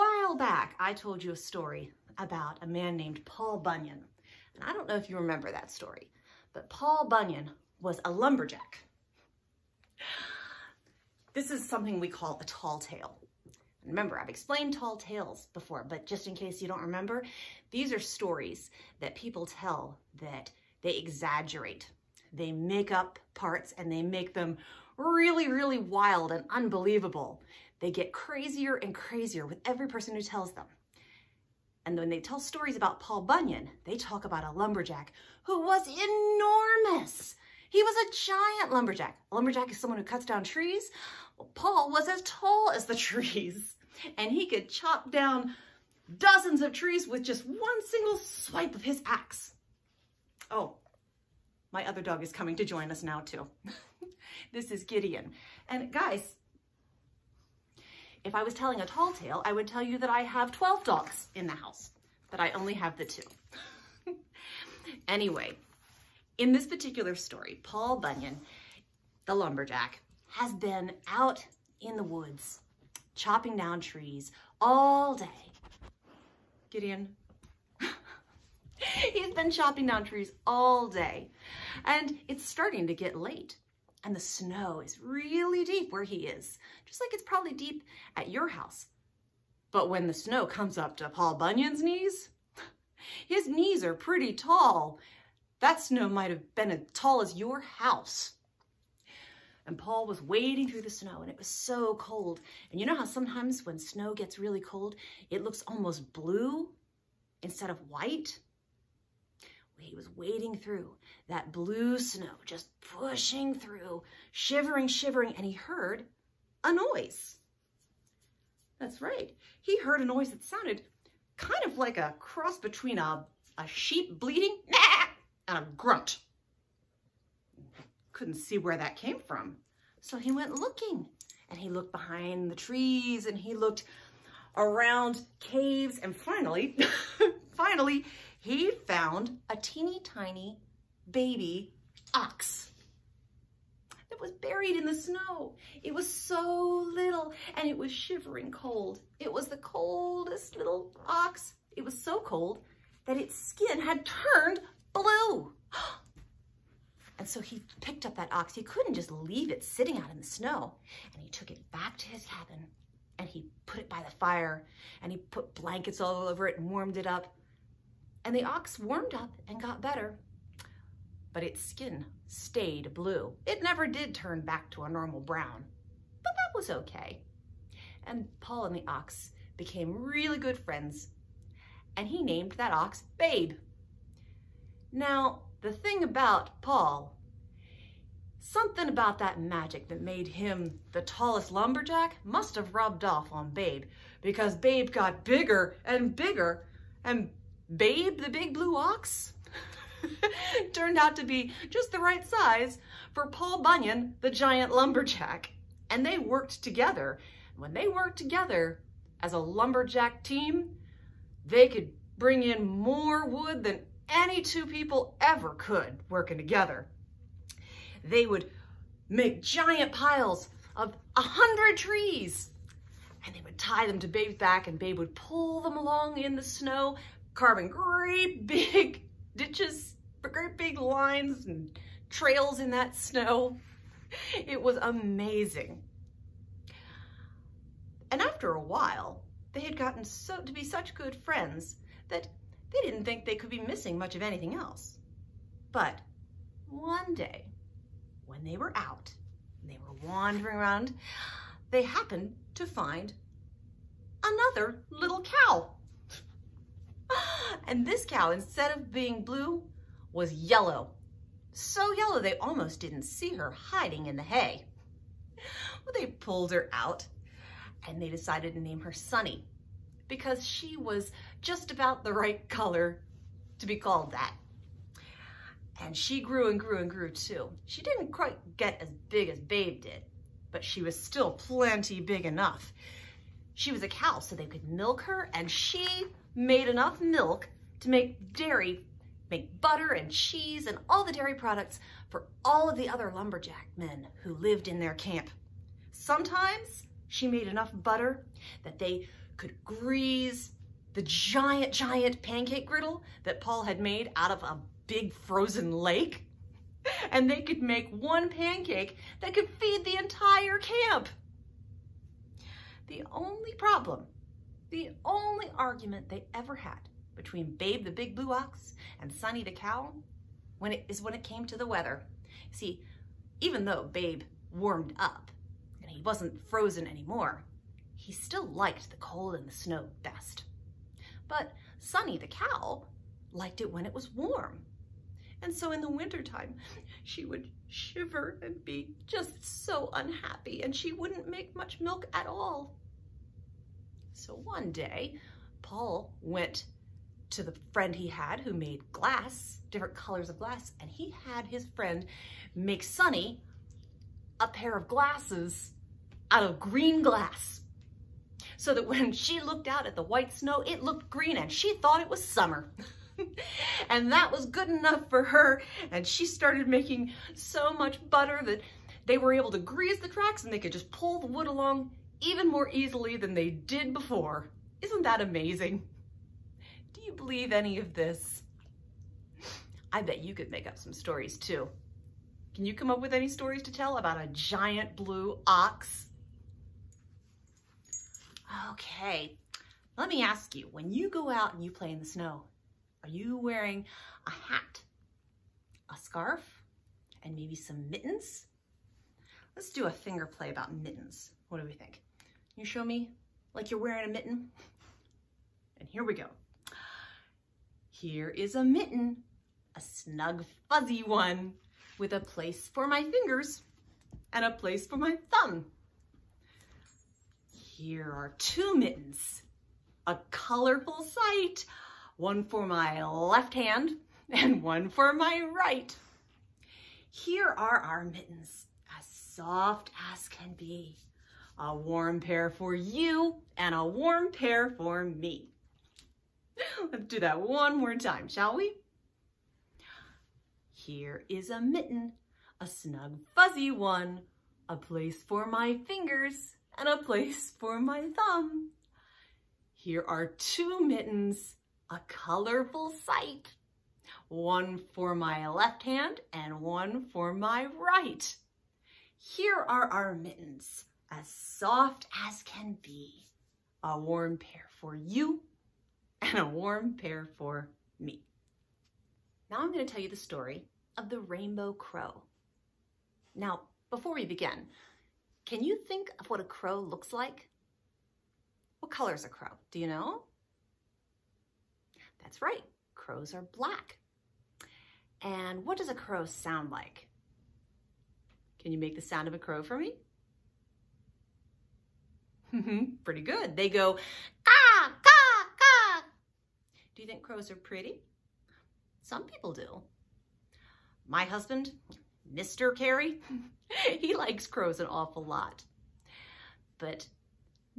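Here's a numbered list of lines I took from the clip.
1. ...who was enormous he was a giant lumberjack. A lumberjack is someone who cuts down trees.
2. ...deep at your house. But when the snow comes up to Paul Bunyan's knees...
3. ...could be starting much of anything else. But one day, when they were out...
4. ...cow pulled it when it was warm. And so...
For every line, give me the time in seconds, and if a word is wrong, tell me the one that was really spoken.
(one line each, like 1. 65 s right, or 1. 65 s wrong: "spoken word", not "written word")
1. 35 s right
2. 87 s right
3. 243 s wrong: "missing", not "starting"
4. 332 s wrong: "liked", not "pulled".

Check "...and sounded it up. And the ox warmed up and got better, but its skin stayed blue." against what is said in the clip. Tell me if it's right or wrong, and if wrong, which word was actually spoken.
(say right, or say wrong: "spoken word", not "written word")
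wrong: "warmed", not "sounded".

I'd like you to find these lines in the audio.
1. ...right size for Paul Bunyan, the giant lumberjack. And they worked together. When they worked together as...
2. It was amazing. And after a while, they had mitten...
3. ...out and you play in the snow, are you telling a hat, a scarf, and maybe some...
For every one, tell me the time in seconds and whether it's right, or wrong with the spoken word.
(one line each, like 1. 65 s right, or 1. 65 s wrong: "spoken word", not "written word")
1. 202 s right
2. 234 s wrong: "gotten", not "mitten"
3. 391 s wrong: "wearing", not "telling".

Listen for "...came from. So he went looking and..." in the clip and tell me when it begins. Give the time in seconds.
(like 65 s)
128 s.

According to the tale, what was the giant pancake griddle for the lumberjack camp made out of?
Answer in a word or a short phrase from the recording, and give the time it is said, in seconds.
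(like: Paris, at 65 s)
a big frozen lake, at 304 s.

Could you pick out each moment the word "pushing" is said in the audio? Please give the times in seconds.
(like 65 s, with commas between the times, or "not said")
112 s.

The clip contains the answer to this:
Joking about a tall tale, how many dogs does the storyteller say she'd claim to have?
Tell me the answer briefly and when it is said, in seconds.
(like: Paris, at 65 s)
12, at 60 s.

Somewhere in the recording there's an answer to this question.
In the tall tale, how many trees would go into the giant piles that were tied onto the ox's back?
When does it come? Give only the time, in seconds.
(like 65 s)
221 s.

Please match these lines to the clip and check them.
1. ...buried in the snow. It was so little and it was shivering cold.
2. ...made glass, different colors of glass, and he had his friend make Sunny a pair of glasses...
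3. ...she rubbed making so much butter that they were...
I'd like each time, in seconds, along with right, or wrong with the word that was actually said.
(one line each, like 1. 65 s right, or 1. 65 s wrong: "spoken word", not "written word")
1. 144 s right
2. 348 s right
3. 366 s wrong: "started", not "rubbed".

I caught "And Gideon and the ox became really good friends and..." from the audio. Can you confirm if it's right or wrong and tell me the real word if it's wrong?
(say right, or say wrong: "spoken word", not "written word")
wrong: "Paul", not "Gideon".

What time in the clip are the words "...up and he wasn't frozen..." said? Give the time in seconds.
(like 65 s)
324 s.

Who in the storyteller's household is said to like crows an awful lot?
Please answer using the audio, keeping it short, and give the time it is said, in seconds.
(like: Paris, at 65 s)
Mr. Carey, at 502 s.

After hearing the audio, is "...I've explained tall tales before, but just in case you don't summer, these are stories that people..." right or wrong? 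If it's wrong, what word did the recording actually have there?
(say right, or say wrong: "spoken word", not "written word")
wrong: "remember", not "summer".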